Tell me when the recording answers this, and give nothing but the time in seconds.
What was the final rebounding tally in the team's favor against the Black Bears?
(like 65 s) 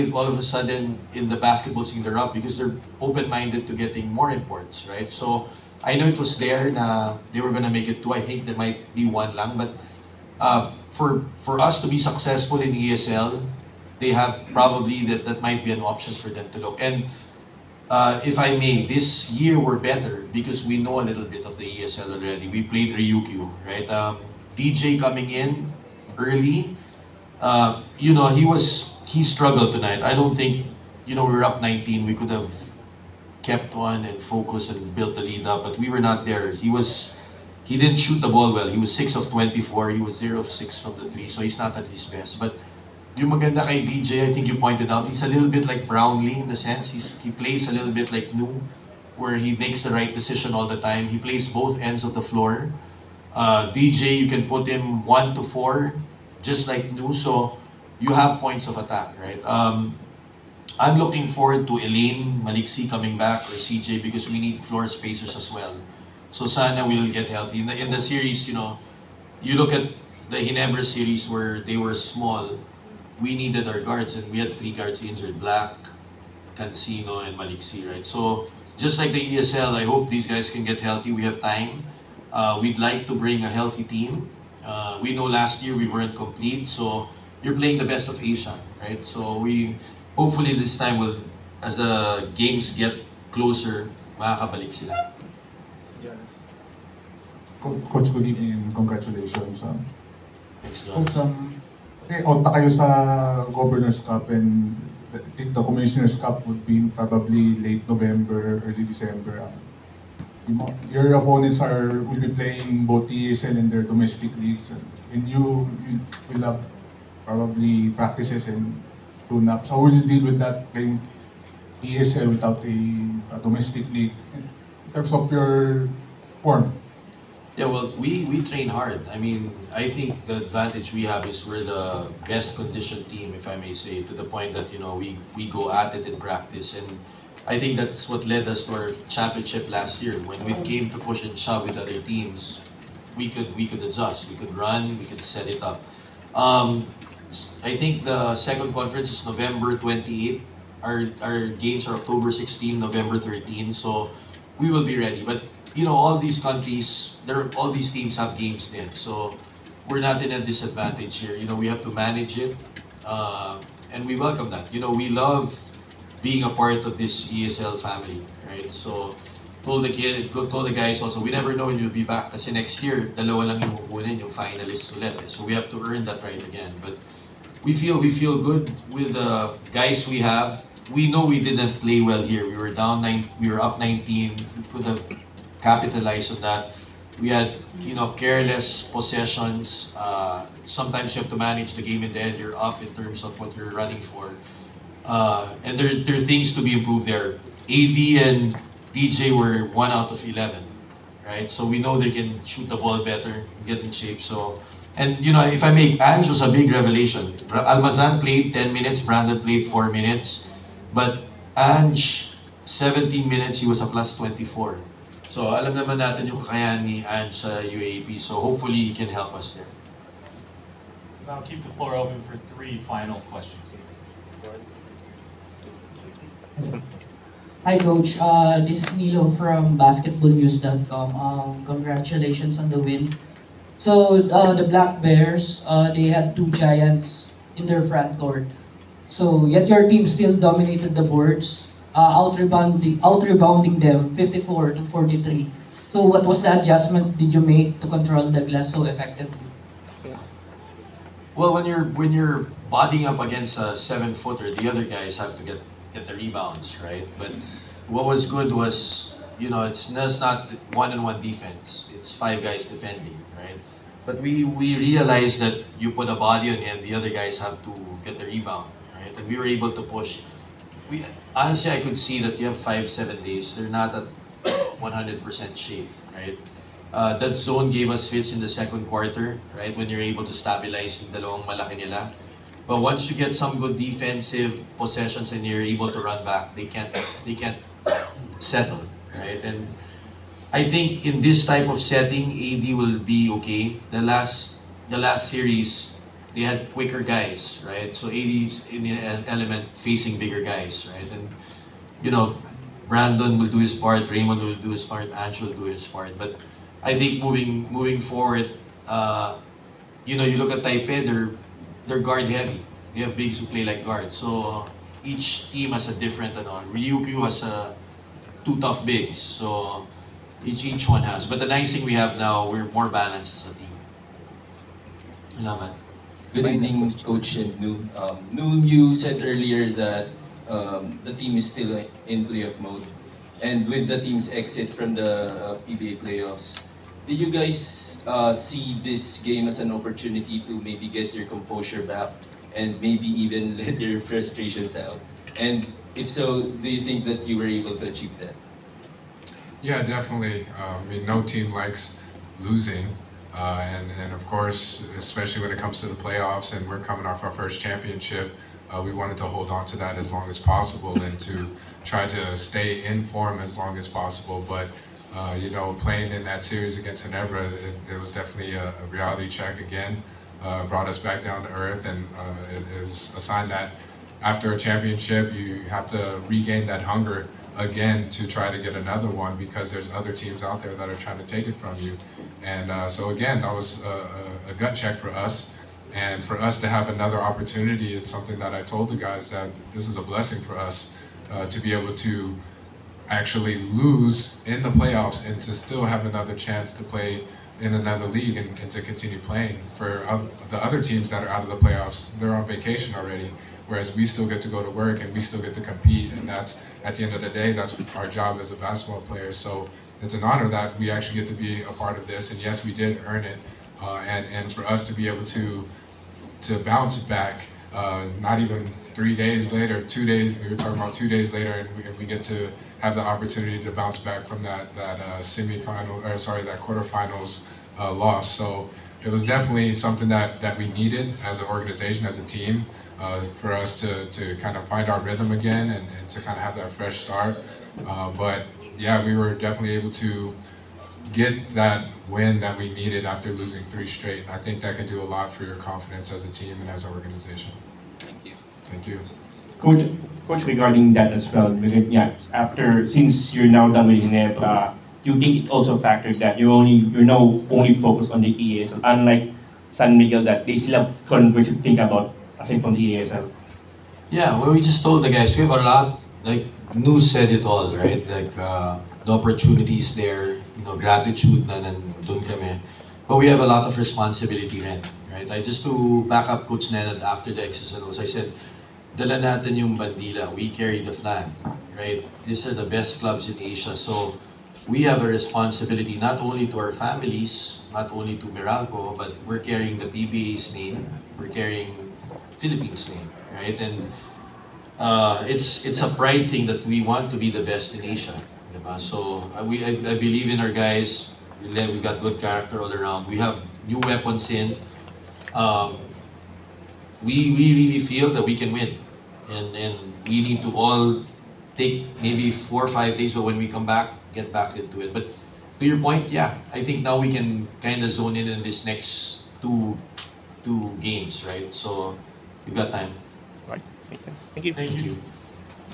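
244 s.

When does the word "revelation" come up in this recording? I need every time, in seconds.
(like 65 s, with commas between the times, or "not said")
206 s.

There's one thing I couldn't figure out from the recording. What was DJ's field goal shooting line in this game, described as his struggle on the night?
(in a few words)
6 of 24.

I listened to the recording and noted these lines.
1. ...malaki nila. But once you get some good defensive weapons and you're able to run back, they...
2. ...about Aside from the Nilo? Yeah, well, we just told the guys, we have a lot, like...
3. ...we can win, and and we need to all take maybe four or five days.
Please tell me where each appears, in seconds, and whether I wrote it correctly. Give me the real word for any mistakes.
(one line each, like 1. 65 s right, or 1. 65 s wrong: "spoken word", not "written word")
1. 281 s wrong: "possessions", not "weapons"
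2. 461 s wrong: "ESL", not "Nilo"
3. 508 s right.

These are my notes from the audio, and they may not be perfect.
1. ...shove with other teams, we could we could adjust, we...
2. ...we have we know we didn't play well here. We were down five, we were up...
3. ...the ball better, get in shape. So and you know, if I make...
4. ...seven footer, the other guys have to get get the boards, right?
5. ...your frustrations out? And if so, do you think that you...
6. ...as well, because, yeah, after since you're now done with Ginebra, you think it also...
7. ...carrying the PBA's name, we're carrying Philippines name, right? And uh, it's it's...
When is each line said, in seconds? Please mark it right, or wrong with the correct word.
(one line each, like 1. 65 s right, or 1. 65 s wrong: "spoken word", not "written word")
1. 141 s right
2. 180 s wrong: "nine", not "five"
3. 202 s right
4. 253 s wrong: "rebounds", not "boards"
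5. 343 s right
6. 451 s right
7. 489 s right.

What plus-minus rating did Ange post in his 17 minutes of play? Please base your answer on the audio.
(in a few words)
plus 24.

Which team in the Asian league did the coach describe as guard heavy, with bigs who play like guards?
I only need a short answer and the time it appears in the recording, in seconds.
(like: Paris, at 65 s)
Taipei, at 310 s.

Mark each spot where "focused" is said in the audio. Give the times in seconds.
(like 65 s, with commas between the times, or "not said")
34 s, 457 s.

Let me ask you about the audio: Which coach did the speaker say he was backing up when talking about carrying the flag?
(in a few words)
Coach Nenad.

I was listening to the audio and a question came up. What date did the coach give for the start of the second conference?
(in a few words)
November 28.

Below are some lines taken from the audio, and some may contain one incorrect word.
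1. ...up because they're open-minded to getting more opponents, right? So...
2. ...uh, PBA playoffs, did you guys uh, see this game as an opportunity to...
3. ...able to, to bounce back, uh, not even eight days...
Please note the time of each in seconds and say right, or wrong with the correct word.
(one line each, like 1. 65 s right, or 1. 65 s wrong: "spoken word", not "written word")
1. 2 s wrong: "imports", not "opponents"
2. 335 s right
3. 415 s wrong: "three", not "eight".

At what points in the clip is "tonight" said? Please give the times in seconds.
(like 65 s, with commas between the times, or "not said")
29 s.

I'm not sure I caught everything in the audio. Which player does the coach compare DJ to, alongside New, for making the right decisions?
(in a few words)
Brownlee.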